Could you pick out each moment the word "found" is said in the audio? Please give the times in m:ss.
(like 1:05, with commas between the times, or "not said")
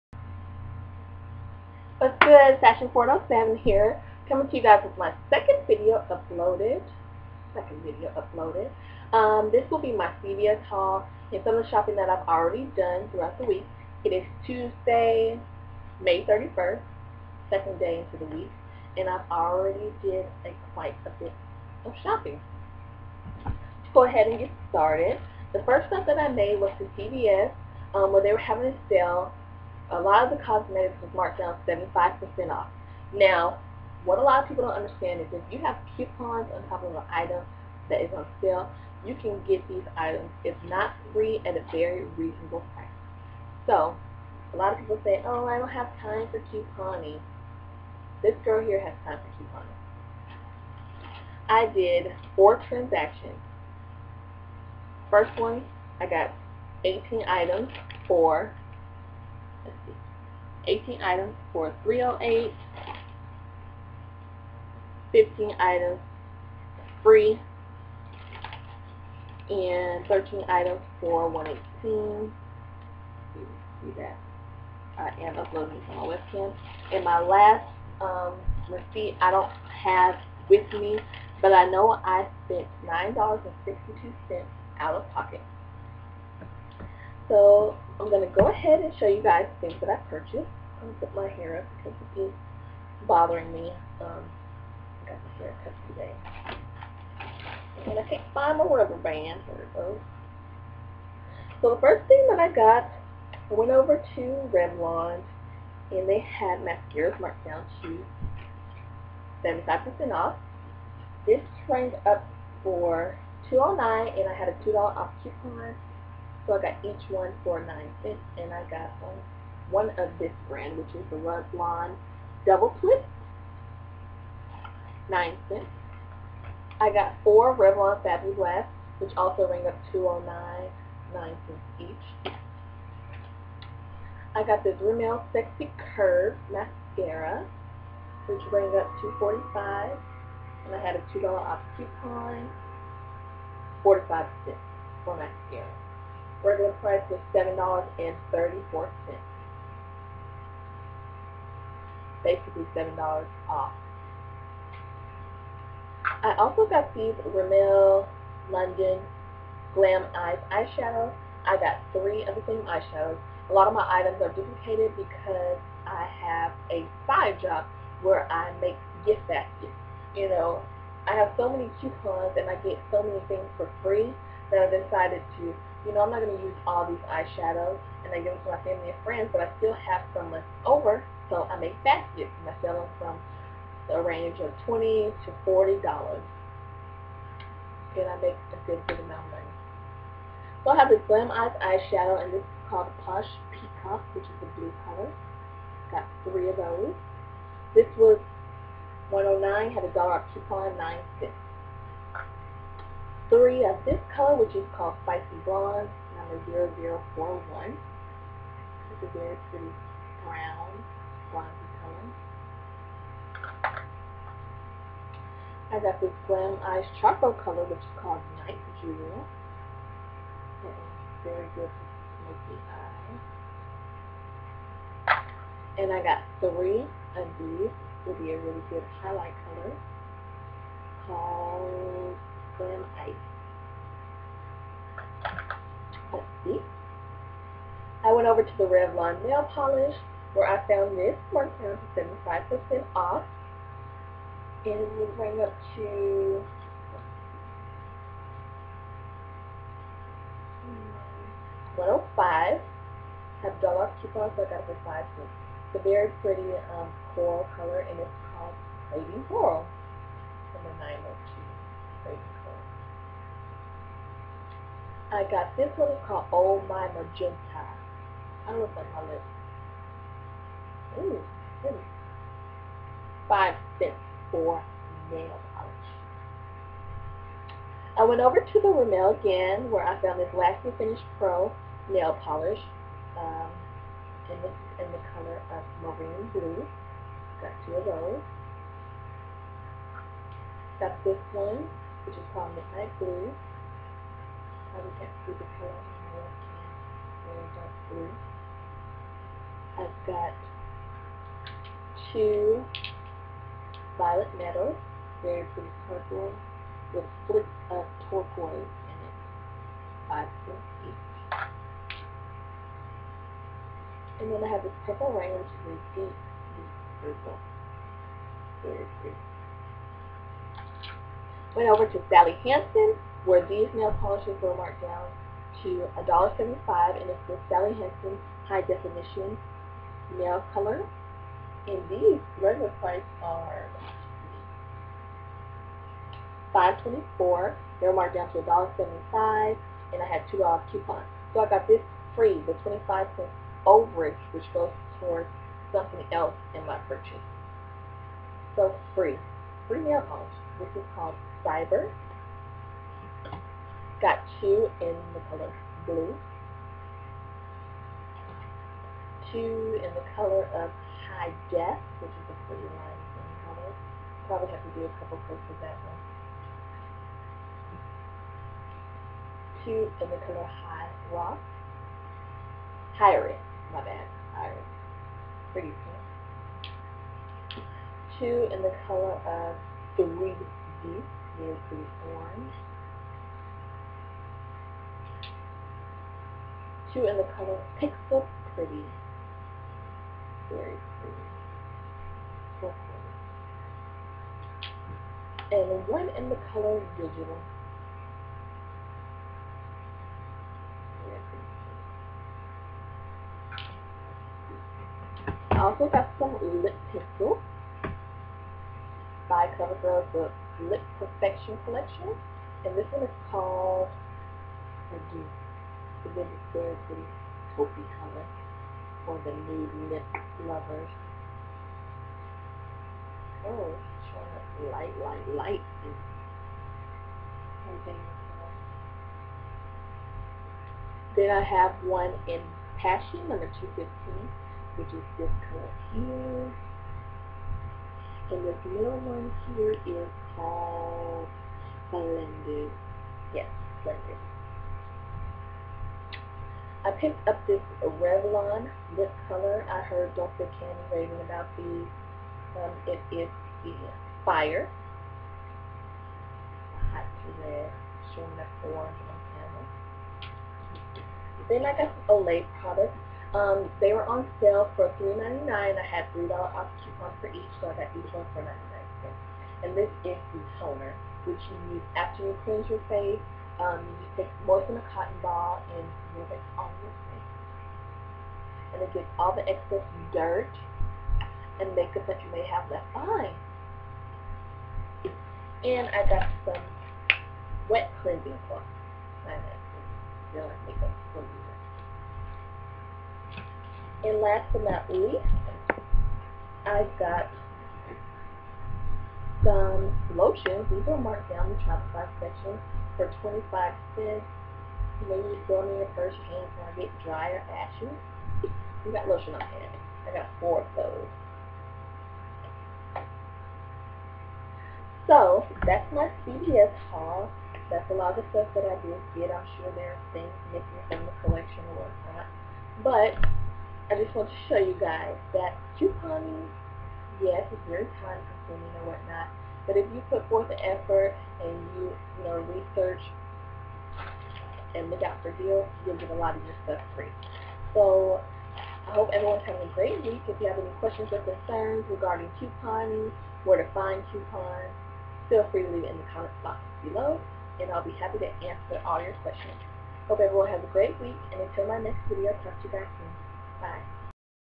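4:00, 4:40.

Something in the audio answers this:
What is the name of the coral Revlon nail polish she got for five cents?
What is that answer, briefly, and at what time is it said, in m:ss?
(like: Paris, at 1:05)
Lady Coral, at 4:18.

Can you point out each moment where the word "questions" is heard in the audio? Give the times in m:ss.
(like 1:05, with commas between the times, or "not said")
9:00, 9:09.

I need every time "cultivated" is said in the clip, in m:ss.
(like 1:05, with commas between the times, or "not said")
not said.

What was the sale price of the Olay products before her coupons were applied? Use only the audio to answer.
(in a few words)
$3.99.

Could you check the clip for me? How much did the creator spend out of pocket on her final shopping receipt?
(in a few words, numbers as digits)
$9.62.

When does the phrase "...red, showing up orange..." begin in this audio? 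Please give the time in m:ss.
7:37.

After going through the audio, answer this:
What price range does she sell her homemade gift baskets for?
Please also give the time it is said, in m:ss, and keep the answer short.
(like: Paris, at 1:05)
$20 to $40, at 3:04.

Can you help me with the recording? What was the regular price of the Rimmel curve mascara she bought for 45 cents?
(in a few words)
$7.34.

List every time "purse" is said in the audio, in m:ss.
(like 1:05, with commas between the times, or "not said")
8:25.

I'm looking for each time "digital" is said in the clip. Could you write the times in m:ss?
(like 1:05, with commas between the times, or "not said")
6:36.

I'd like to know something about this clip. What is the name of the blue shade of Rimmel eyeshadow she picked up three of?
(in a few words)
Posh Peacock.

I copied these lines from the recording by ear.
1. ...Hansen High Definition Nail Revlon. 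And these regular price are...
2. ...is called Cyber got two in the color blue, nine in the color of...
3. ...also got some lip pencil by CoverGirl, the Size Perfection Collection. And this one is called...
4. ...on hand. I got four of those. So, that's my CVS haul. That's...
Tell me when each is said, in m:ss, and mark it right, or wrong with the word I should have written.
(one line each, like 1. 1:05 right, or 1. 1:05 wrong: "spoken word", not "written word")
1. 5:27 wrong: "Color", not "Revlon"
2. 5:50 wrong: "two", not "nine"
3. 6:45 wrong: "Lip", not "Size"
4. 8:29 right.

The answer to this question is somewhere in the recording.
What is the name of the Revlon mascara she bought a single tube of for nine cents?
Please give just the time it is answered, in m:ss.
2:01.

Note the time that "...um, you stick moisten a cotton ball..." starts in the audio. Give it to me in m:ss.
7:53.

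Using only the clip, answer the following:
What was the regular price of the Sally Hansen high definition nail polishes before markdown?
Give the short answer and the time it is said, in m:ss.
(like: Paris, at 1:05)
$5.24, at 5:36.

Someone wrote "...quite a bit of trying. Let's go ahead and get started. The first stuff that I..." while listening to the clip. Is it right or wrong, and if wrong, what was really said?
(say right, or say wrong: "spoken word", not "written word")
wrong: "shopping", not "trying".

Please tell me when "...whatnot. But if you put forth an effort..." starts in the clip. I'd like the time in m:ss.
8:48.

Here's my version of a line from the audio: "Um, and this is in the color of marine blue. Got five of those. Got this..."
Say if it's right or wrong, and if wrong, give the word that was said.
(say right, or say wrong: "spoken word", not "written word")
wrong: "two", not "five".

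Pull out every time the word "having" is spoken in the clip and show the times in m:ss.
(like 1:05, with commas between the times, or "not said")
0:28, 8:59.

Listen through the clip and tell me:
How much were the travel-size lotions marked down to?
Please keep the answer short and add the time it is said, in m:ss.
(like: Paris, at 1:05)
25 cents, at 8:23.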